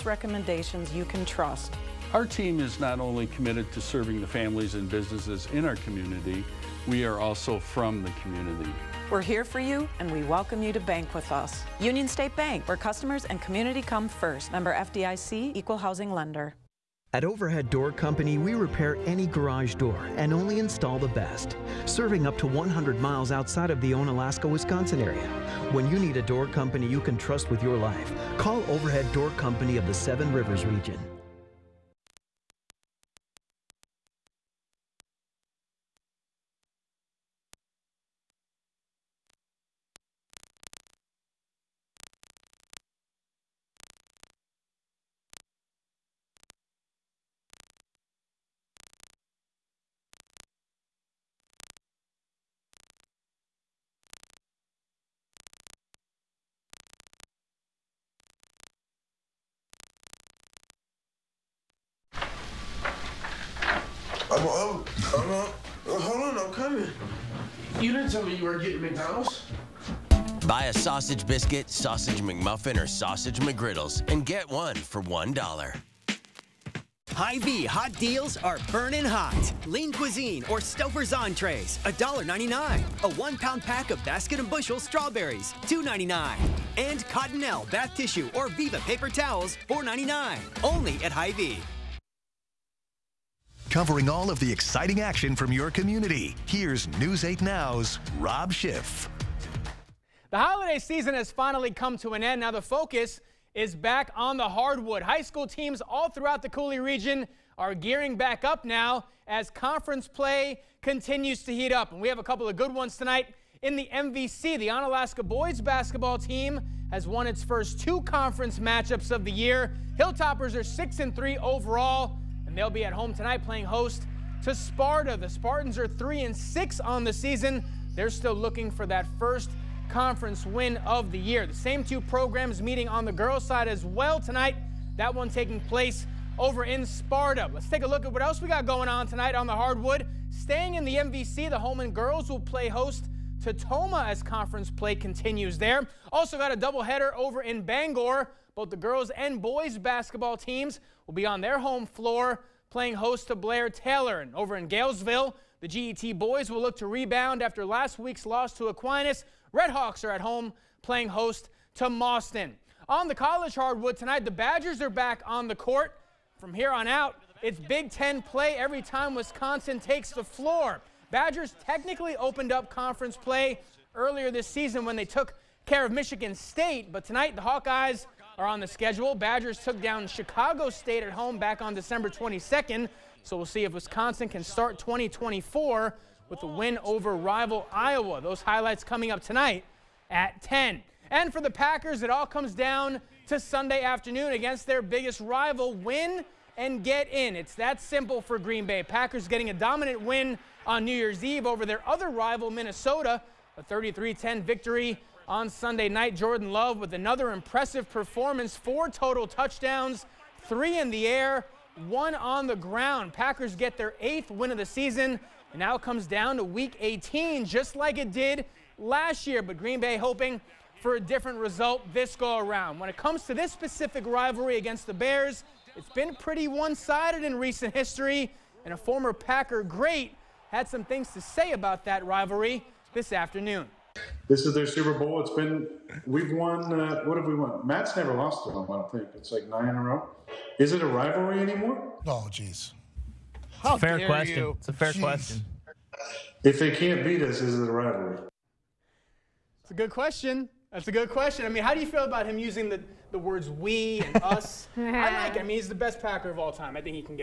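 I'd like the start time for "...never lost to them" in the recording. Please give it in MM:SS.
03:57.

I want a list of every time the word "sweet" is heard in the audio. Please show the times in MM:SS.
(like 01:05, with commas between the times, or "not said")
not said.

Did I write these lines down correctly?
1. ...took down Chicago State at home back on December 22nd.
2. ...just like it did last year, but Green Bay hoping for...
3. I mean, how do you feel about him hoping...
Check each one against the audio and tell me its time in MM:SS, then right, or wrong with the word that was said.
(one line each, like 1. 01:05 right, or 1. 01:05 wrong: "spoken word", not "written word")
1. 02:59 right
2. 03:37 right
3. 04:11 wrong: "using", not "hoping".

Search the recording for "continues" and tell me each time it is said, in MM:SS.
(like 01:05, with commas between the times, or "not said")
01:50, 02:24.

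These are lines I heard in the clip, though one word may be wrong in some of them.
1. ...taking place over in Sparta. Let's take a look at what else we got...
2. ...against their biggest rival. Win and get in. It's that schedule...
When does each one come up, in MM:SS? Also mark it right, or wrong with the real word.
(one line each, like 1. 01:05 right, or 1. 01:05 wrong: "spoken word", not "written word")
1. 02:15 right
2. 03:14 wrong: "simple", not "schedule".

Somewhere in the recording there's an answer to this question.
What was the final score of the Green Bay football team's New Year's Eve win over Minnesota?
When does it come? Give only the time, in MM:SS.
03:23.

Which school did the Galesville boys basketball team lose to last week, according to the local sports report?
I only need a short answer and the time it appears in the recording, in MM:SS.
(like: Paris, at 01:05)
Aquinas, at 02:38.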